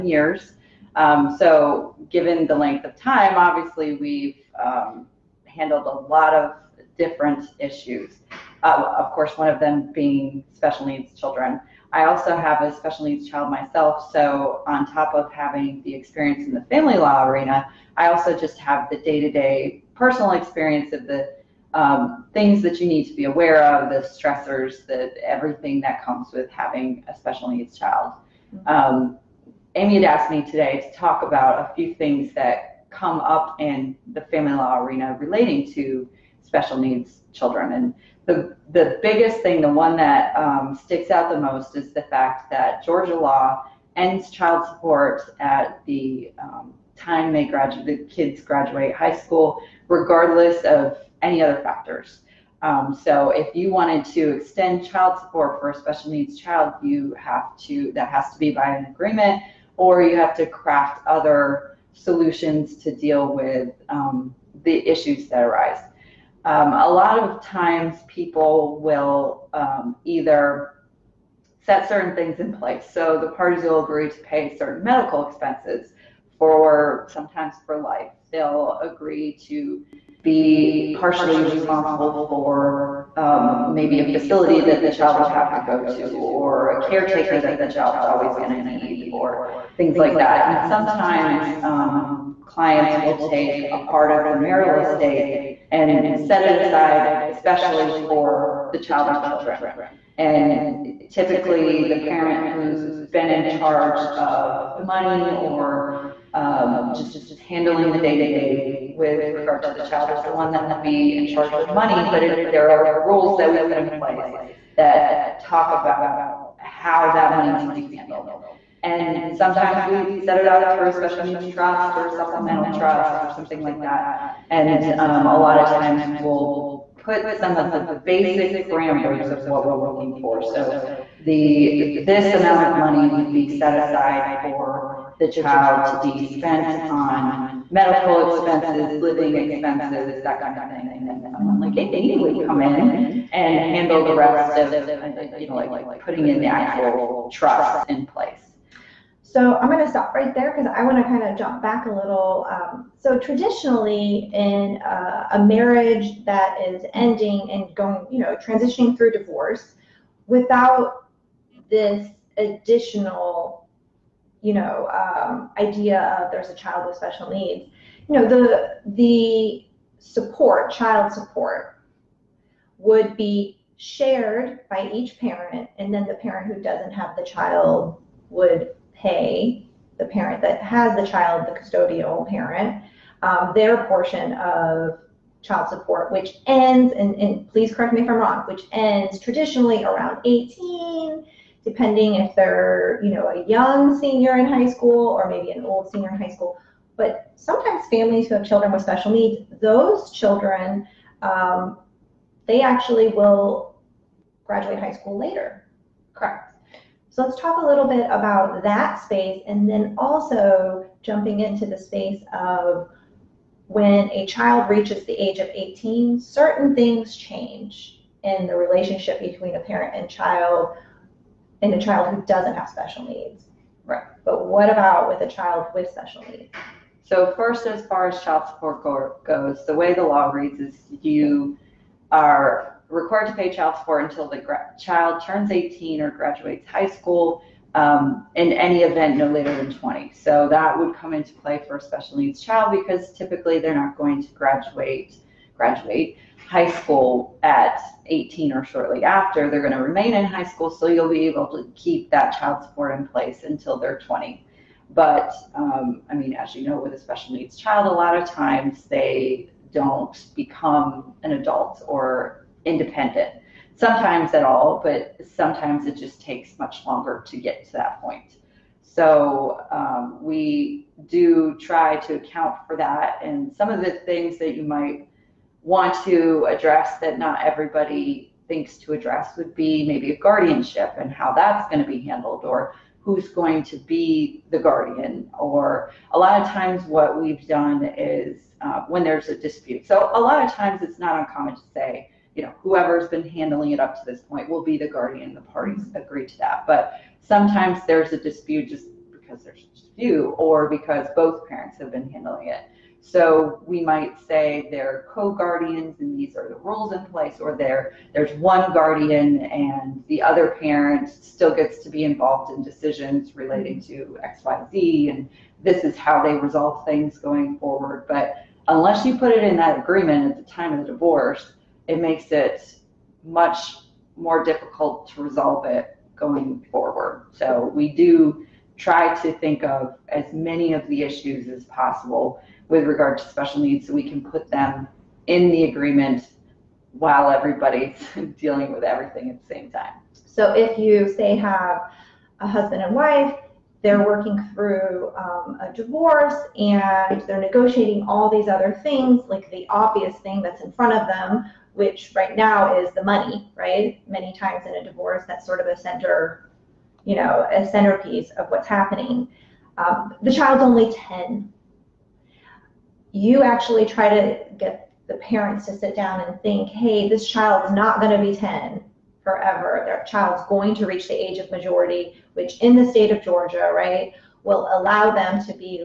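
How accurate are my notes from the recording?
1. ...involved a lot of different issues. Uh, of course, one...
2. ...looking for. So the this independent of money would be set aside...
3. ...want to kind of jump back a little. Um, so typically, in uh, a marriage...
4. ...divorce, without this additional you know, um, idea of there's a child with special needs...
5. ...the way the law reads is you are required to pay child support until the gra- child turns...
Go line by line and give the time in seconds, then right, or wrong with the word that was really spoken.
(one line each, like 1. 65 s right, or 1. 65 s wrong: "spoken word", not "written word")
1. 5 s wrong: "handled", not "involved"
2. 129 s wrong: "amount", not "independent"
3. 150 s wrong: "traditionally", not "typically"
4. 159 s right
5. 229 s right.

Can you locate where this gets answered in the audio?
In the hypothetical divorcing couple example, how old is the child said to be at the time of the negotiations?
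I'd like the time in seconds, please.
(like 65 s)
360 s.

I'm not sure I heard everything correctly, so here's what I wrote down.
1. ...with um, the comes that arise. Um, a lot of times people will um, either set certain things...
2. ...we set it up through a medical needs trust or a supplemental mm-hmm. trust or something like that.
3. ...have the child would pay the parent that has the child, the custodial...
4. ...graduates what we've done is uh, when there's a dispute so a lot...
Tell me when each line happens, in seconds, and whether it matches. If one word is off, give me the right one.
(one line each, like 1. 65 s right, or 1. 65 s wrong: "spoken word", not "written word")
1. 63 s wrong: "issues", not "comes"
2. 119 s wrong: "special", not "medical"
3. 176 s right
4. 286 s wrong: "times", not "graduates".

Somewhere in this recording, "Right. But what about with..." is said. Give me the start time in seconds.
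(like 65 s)
223 s.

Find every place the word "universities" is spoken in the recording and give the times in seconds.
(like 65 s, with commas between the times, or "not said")
not said.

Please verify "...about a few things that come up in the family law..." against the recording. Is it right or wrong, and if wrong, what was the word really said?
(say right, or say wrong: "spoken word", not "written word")
right.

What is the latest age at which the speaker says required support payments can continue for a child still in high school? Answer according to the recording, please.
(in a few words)
20.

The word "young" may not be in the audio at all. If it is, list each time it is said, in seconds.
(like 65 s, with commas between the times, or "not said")
193 s.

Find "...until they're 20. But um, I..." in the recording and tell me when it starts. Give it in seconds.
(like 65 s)
253 s.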